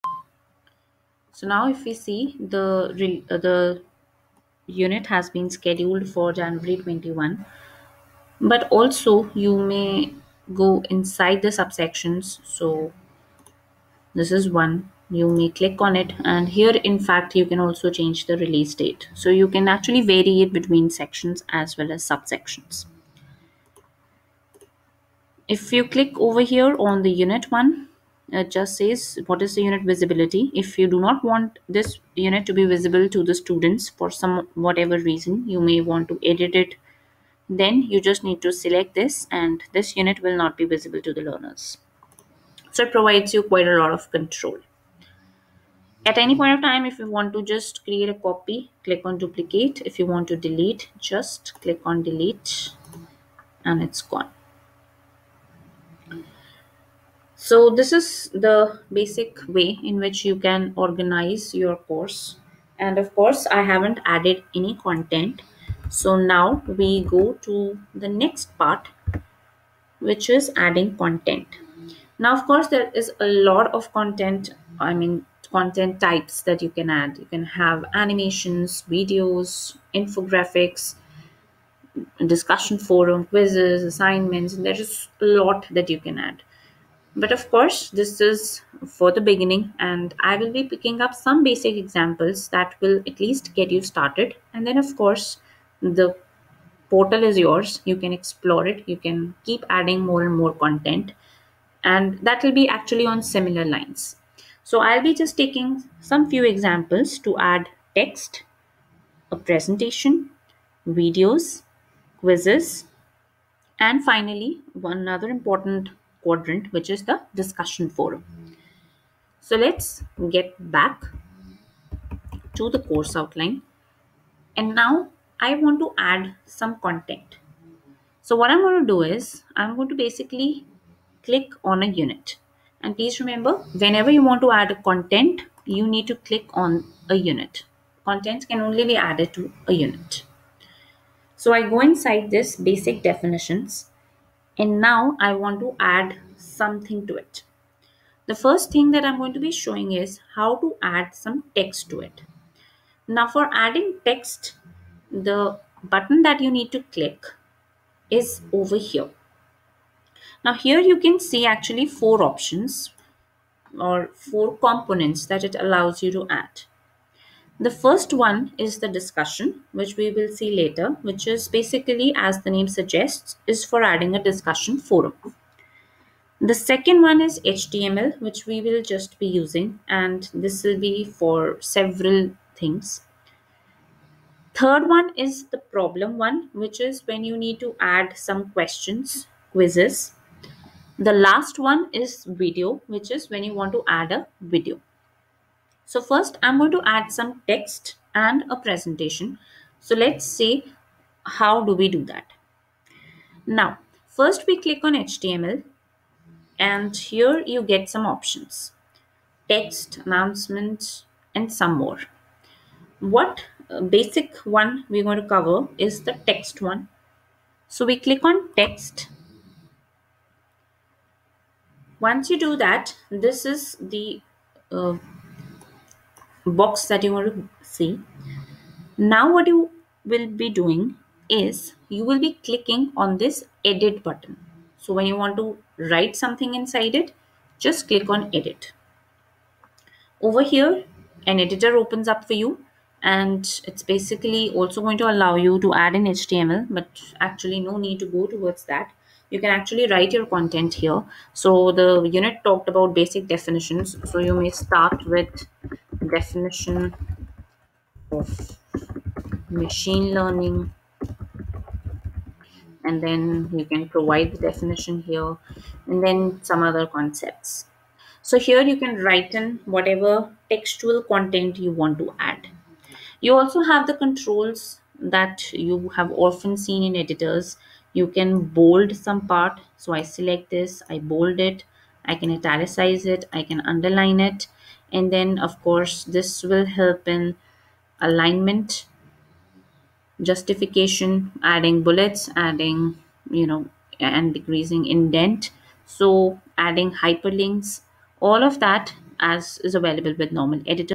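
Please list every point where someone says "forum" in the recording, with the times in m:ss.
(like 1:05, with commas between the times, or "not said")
1:22, 1:57, 2:54.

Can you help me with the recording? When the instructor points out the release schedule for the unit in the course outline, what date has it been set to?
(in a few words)
January 21.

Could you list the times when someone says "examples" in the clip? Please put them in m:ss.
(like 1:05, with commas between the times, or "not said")
1:31, 1:46.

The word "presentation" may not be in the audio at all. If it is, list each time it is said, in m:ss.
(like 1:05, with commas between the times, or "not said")
1:49, 3:18.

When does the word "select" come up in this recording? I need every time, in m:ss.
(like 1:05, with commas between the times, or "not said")
0:38, 4:40.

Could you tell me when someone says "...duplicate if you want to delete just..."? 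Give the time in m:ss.
0:49.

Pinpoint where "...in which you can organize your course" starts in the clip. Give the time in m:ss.
0:59.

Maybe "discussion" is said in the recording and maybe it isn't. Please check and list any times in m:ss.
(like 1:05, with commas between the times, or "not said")
1:22, 1:57, 2:48, 2:54.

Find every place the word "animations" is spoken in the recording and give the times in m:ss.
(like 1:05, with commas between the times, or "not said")
1:17.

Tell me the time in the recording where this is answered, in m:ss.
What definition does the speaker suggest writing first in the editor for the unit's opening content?
4:16.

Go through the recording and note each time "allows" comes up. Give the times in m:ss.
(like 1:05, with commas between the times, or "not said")
2:45, 4:05.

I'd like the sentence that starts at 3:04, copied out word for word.
Third one is the problem one, which is when you need to add some questions, quizzes.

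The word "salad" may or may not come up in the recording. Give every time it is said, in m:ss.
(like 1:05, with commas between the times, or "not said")
not said.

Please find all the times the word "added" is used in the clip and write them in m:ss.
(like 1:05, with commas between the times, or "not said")
1:04, 2:18.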